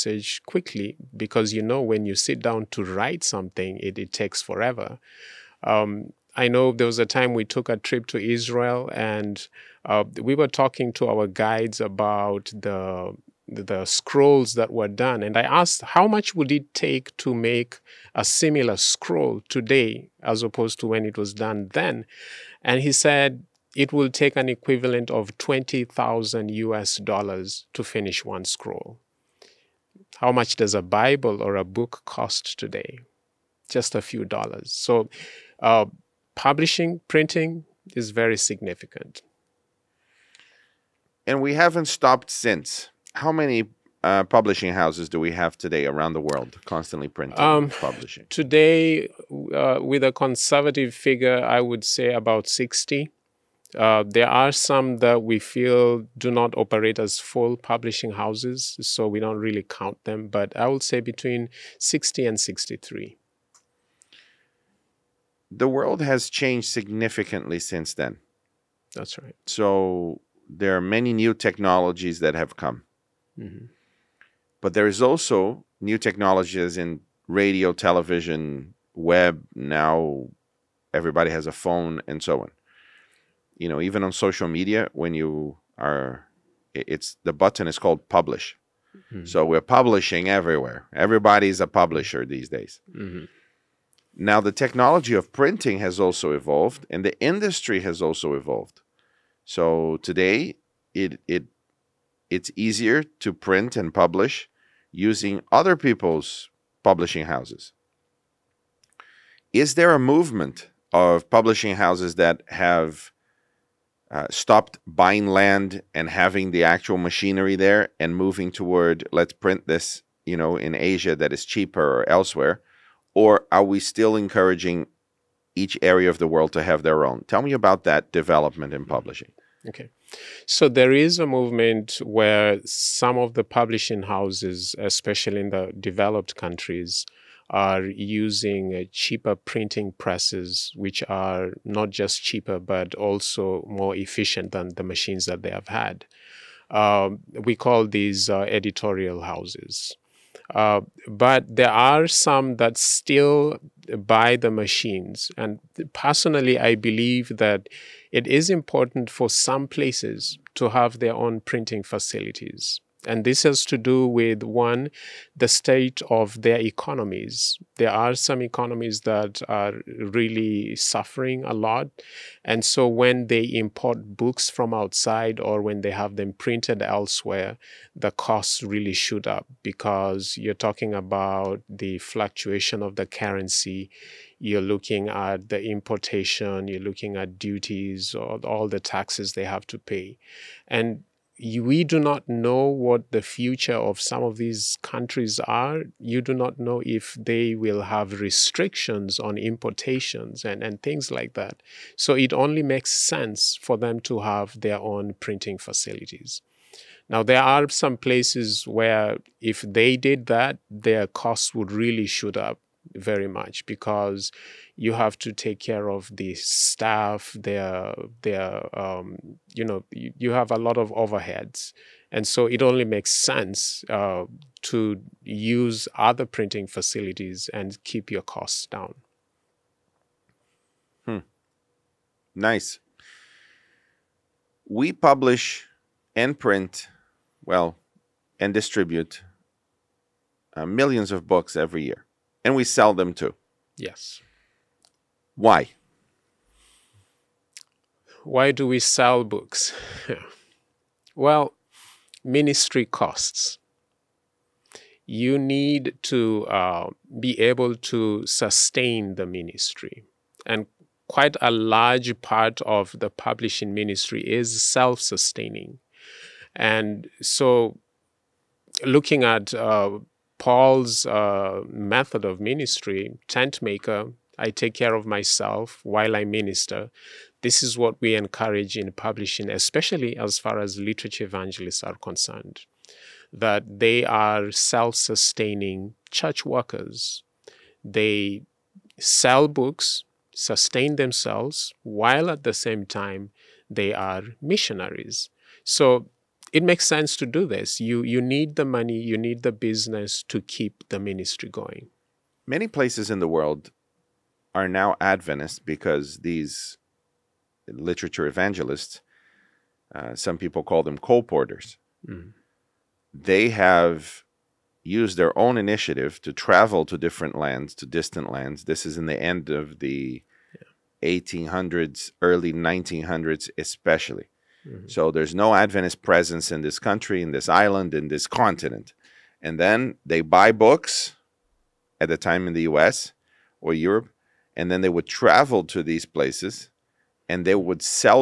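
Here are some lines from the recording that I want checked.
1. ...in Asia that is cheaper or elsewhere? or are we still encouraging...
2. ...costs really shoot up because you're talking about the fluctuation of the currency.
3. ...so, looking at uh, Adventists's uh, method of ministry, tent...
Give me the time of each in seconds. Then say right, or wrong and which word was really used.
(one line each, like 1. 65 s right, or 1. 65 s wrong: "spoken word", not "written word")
1. 120 s right
2. 178 s right
3. 267 s wrong: "Paul", not "Adventists".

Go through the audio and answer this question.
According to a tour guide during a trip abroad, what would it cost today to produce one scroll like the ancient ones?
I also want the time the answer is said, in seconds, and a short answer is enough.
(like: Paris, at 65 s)
$20,000, at 25 s.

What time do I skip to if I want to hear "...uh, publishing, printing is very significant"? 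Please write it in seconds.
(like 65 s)
35 s.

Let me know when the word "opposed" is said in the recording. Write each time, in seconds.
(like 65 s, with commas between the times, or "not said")
20 s.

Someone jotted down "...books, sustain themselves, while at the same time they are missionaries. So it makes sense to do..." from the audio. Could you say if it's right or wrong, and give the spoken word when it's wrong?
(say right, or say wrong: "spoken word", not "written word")
right.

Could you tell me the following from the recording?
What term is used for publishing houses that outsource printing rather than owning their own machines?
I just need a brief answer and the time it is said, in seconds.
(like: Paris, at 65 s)
editorial houses, at 148 s.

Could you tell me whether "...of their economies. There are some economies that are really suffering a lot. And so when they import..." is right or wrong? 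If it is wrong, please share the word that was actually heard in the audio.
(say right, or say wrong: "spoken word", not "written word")
right.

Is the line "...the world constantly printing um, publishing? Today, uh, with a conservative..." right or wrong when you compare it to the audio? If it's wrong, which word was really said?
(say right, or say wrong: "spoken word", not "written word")
right.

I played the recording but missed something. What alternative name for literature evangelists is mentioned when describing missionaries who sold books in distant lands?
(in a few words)
colporters.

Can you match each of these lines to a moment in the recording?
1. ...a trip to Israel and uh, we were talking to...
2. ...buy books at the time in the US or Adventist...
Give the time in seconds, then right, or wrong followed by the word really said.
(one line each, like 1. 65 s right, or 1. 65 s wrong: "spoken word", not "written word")
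1. 7 s right
2. 330 s wrong: "Europe", not "Adventist".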